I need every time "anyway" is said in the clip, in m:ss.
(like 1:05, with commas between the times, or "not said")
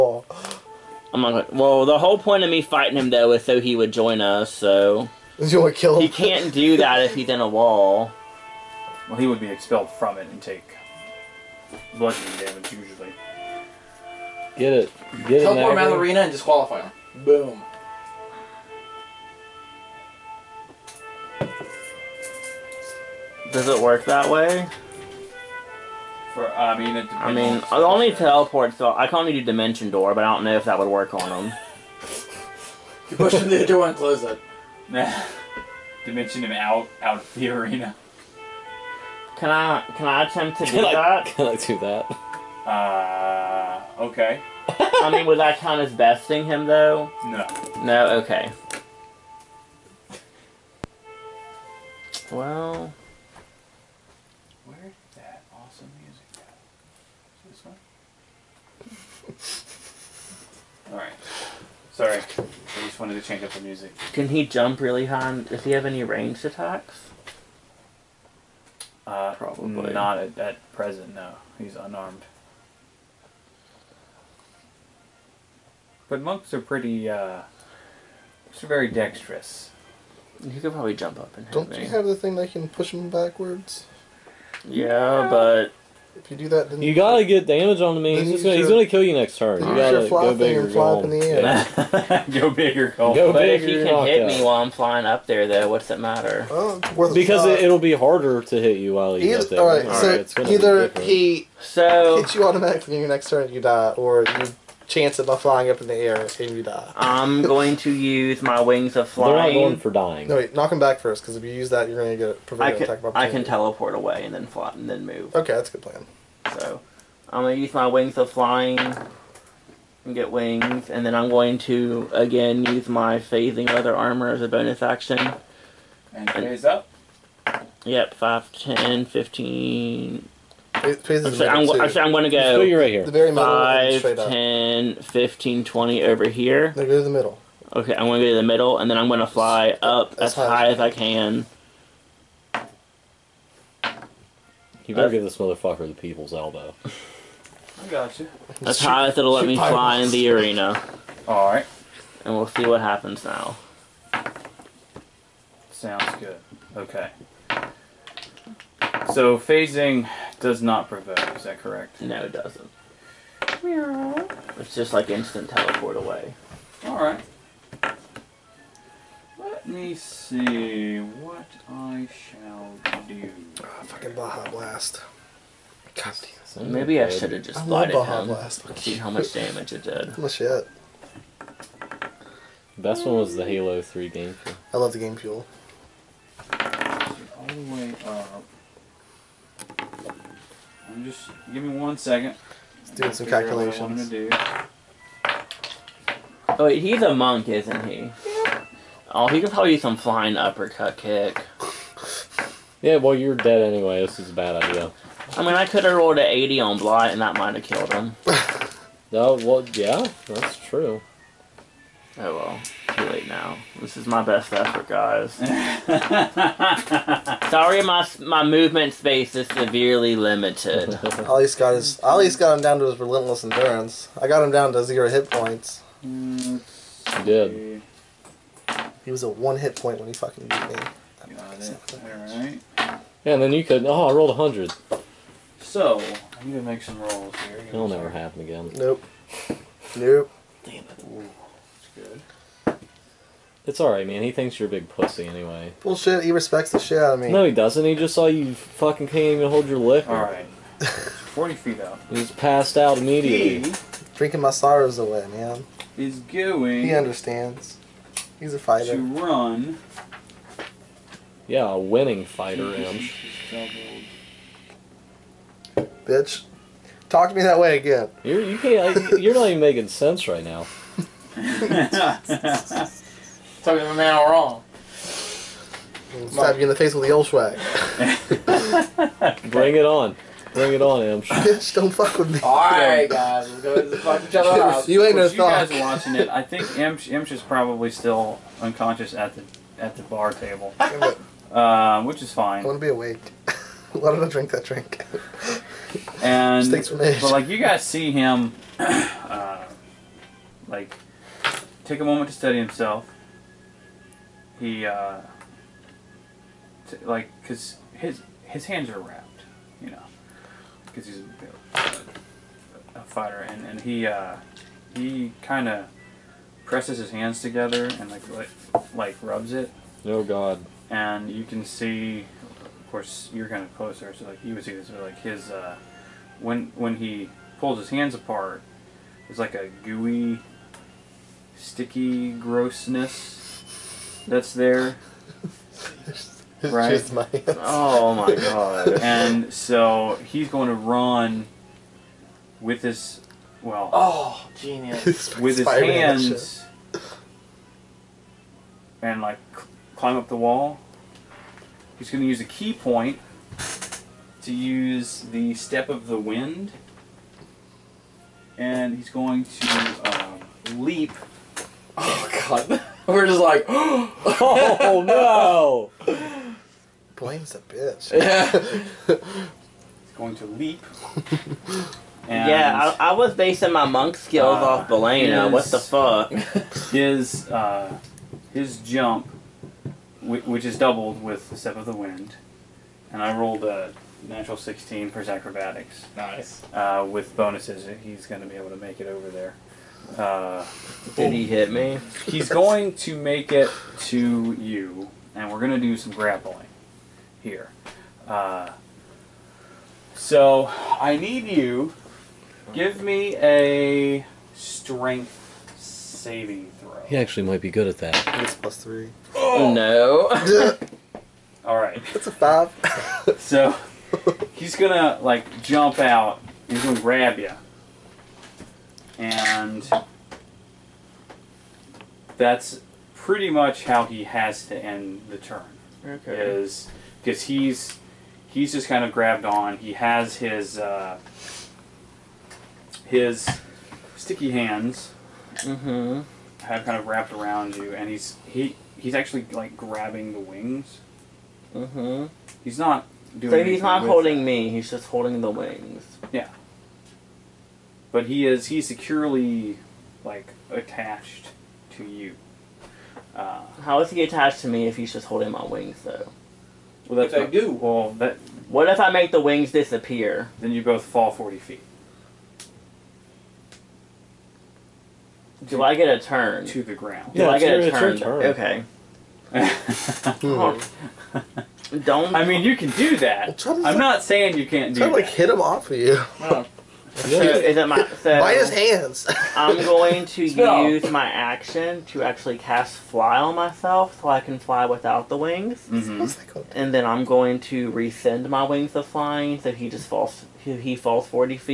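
3:23, 4:05.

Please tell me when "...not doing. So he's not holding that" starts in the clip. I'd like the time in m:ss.
7:22.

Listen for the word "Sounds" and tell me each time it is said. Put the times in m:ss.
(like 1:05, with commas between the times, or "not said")
2:35.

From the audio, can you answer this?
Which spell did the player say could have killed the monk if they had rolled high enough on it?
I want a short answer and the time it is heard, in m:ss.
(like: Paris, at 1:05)
Blight, at 3:26.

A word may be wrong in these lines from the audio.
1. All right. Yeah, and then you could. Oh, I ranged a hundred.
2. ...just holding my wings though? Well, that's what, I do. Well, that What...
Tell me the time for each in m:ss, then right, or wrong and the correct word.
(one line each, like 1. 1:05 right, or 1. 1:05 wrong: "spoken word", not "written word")
1. 3:51 wrong: "rolled", not "ranged"
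2. 7:35 right.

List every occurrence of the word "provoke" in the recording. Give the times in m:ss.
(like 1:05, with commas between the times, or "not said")
2:40.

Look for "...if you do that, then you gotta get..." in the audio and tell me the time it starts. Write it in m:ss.
1:26.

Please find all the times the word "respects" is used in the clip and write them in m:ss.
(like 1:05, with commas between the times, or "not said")
4:06.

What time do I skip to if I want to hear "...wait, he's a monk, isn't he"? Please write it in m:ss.
3:16.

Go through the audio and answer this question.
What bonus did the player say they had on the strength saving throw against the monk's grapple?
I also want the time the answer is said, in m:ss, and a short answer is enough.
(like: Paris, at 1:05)
+3, at 6:48.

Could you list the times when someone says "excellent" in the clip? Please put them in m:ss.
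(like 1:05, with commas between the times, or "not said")
not said.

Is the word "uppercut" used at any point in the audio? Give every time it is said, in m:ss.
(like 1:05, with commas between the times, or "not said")
3:20.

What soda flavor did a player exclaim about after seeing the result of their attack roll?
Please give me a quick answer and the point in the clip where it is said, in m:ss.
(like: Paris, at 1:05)
Baja Blast, at 2:54.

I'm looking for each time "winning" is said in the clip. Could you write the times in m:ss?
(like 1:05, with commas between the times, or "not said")
4:21.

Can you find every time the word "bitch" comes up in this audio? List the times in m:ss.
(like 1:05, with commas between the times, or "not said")
4:26, 4:41, 6:07.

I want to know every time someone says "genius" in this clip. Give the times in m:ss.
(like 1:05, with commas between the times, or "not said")
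5:44.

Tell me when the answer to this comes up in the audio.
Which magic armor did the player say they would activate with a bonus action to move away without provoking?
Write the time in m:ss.
2:03.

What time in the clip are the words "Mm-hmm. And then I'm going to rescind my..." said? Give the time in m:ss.
8:05.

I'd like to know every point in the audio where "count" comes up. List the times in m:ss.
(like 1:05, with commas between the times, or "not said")
0:45.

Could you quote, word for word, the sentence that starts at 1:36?
Oh, well, because it, will be harder to hit you while you get there.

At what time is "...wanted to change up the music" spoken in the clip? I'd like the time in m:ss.
1:02.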